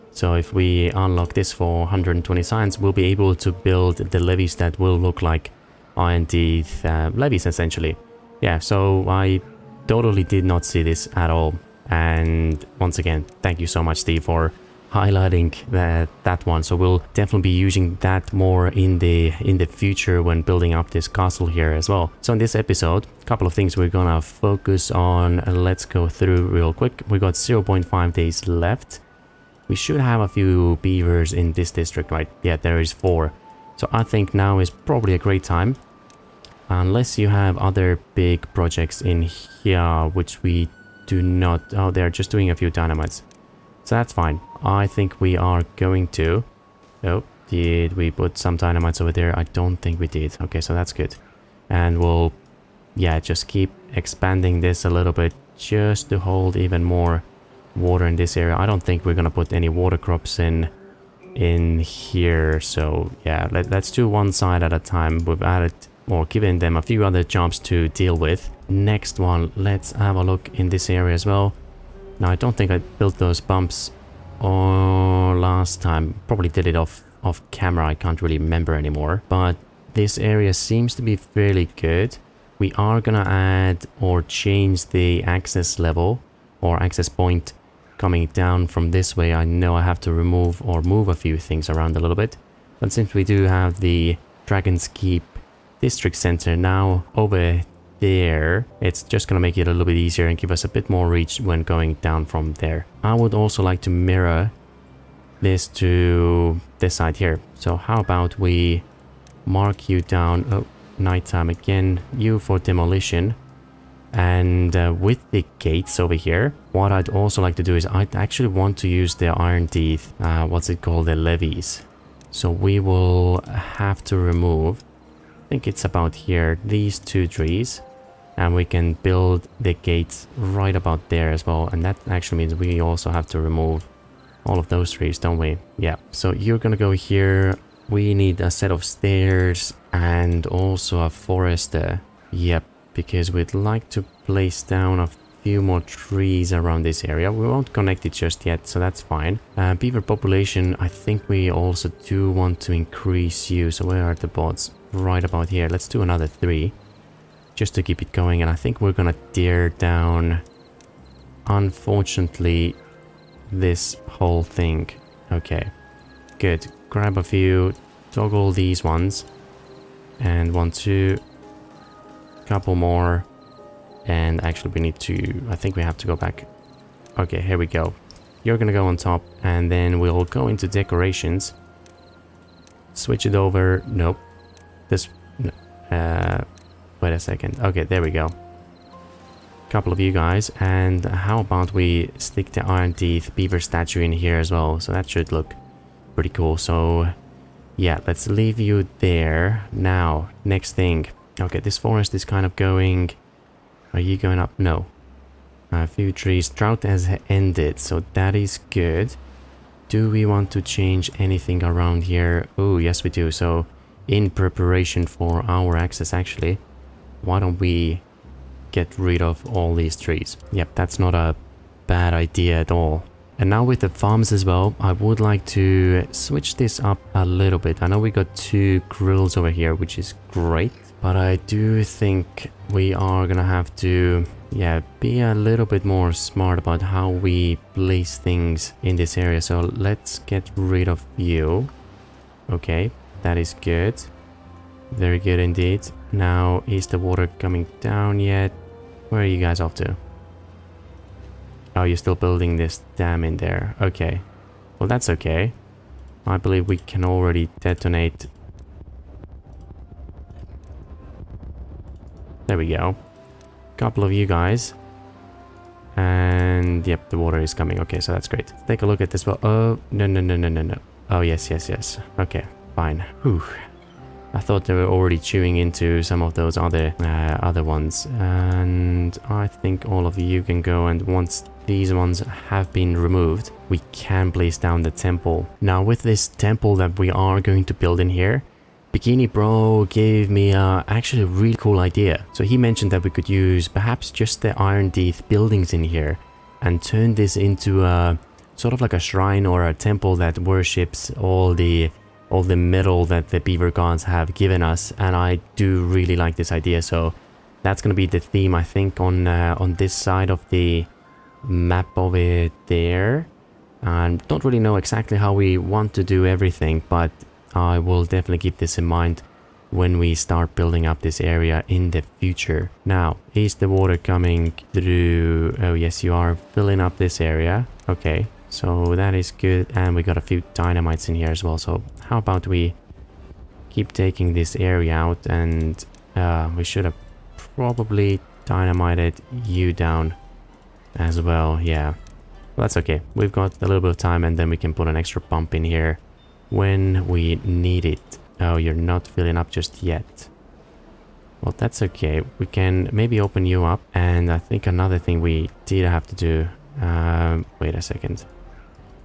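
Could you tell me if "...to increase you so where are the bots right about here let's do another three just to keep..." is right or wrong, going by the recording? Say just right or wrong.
right.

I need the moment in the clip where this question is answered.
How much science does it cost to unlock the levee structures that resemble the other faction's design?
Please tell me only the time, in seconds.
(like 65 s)
1 s.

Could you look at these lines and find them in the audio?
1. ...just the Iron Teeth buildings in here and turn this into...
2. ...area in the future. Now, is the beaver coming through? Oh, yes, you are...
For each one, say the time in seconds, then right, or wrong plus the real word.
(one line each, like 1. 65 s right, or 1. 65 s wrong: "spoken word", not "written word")
1. 294 s right
2. 321 s wrong: "water", not "beaver".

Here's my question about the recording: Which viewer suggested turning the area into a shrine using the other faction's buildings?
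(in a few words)
Bikini Bro.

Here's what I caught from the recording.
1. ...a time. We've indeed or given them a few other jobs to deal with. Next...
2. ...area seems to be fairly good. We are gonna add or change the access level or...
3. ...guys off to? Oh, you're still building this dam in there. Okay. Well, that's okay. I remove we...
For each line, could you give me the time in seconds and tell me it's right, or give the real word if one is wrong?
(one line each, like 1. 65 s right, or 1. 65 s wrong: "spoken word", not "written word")
1. 64 s wrong: "added", not "indeed"
2. 80 s right
3. 249 s wrong: "believe", not "remove".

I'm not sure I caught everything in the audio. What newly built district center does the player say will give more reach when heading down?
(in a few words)
Dragon's Keep.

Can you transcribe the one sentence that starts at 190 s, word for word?
And how about we stick the Iron Teeth Beaver statue in here as well.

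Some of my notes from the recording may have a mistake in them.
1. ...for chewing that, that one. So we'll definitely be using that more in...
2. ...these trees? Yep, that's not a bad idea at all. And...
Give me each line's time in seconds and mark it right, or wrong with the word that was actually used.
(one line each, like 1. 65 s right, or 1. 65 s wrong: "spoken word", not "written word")
1. 14 s wrong: "highlighting", not "chewing"
2. 219 s right.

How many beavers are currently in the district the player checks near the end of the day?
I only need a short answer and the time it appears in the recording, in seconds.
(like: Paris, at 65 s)
4, at 32 s.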